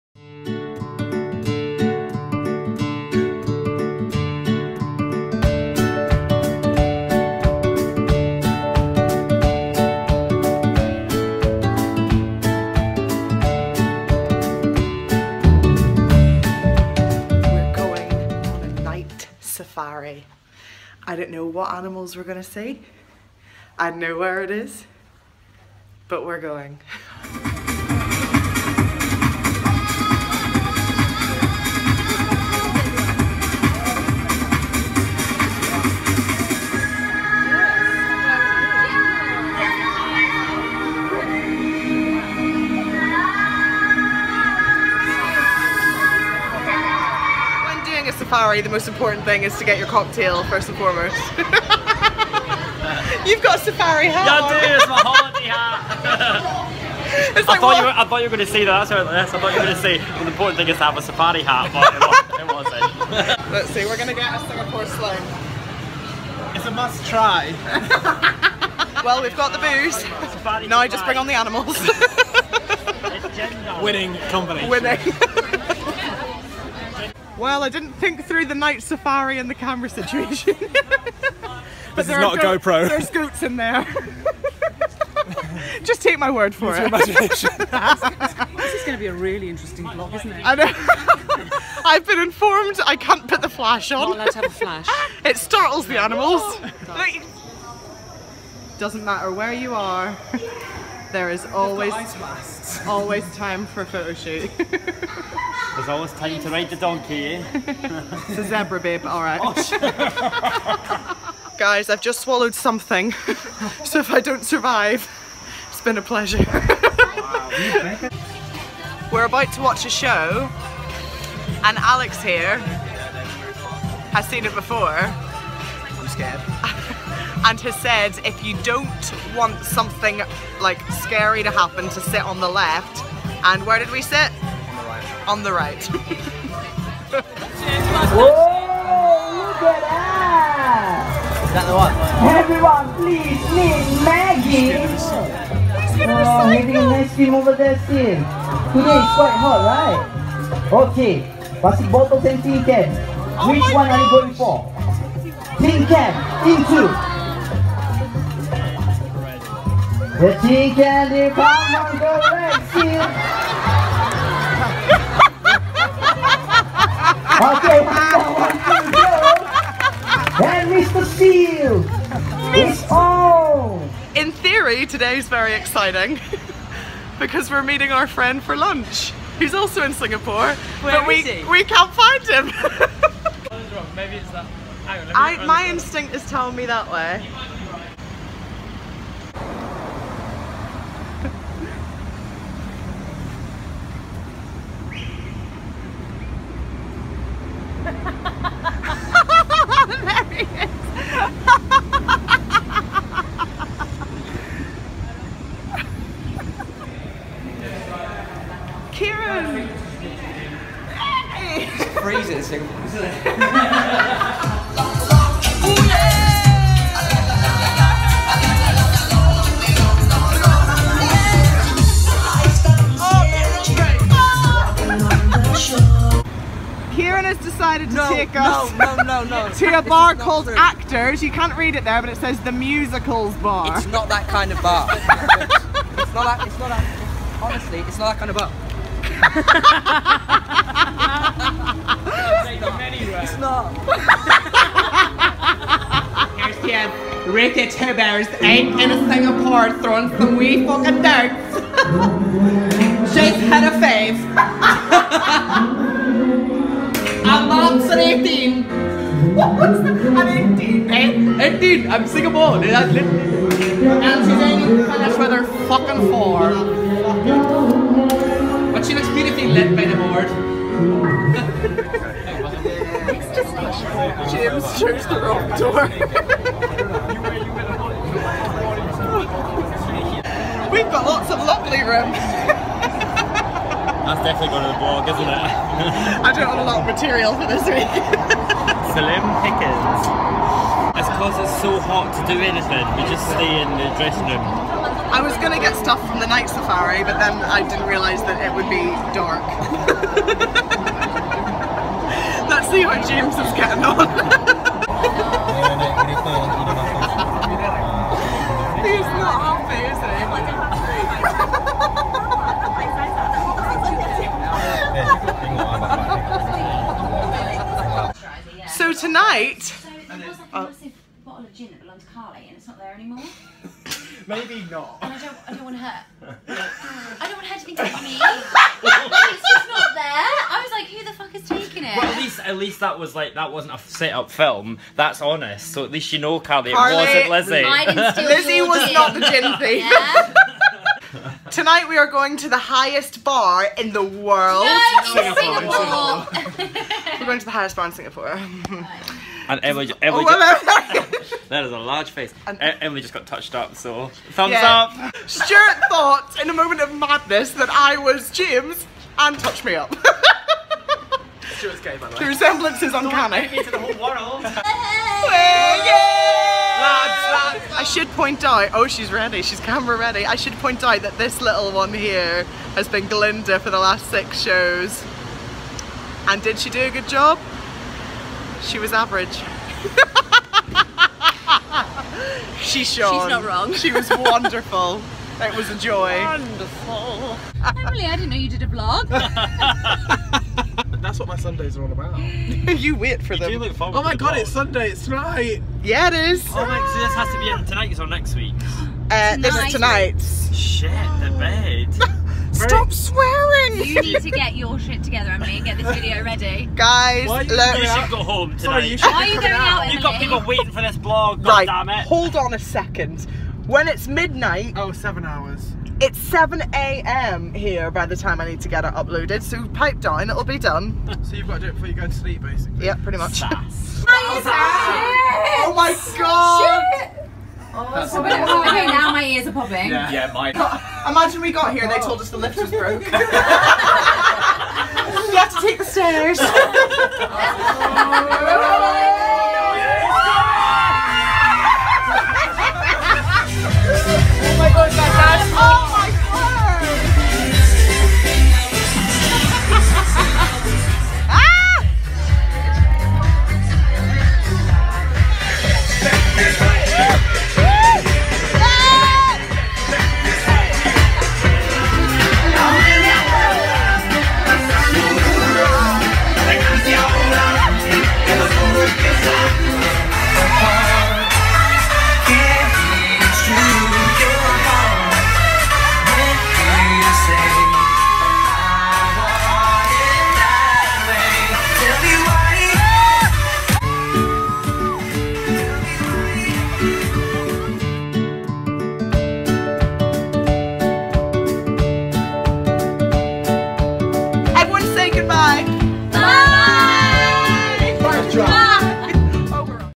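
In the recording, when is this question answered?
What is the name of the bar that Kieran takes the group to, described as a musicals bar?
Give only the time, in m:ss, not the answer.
3:50.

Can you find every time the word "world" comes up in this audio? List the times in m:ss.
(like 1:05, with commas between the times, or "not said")
5:44, 6:03.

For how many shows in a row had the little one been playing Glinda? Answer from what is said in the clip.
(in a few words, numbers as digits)
6.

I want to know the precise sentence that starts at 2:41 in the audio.
chicken, the bomb, the red seal.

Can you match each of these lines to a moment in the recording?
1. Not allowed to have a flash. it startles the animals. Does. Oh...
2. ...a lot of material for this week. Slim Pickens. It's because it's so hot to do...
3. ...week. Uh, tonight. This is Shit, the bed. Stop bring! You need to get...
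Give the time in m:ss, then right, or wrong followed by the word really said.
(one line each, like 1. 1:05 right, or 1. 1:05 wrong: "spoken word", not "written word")
1. 1:34 right
2. 4:46 right
3. 6:38 wrong: "swearing", not "bring".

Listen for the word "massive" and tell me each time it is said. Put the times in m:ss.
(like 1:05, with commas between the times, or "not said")
5:20.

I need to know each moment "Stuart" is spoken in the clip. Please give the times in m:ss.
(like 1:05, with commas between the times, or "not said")
5:55, 6:01.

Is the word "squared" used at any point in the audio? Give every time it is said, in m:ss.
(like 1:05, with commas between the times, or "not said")
not said.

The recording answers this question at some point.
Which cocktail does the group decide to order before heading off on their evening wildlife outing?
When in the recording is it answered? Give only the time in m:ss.
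1:04.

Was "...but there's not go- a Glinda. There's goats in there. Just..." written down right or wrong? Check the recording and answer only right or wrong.
wrong.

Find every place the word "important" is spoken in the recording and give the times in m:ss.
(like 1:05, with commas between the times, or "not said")
0:48, 1:00.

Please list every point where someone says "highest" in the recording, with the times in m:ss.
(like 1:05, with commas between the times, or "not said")
5:42, 5:47.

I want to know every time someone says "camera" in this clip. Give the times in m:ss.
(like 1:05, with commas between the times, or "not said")
1:19, 6:09.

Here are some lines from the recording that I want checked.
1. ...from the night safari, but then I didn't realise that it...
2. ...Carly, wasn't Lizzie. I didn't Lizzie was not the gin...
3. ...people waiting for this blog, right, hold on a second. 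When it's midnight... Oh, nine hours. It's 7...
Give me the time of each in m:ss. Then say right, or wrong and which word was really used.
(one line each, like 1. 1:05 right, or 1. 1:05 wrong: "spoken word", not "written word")
1. 4:56 right
2. 5:36 right
3. 6:50 wrong: "seven", not "nine".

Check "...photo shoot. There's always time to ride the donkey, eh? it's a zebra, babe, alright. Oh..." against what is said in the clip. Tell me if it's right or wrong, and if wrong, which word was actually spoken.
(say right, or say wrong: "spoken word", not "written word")
right.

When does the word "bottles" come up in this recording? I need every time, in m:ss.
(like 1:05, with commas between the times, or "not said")
2:31, 5:21.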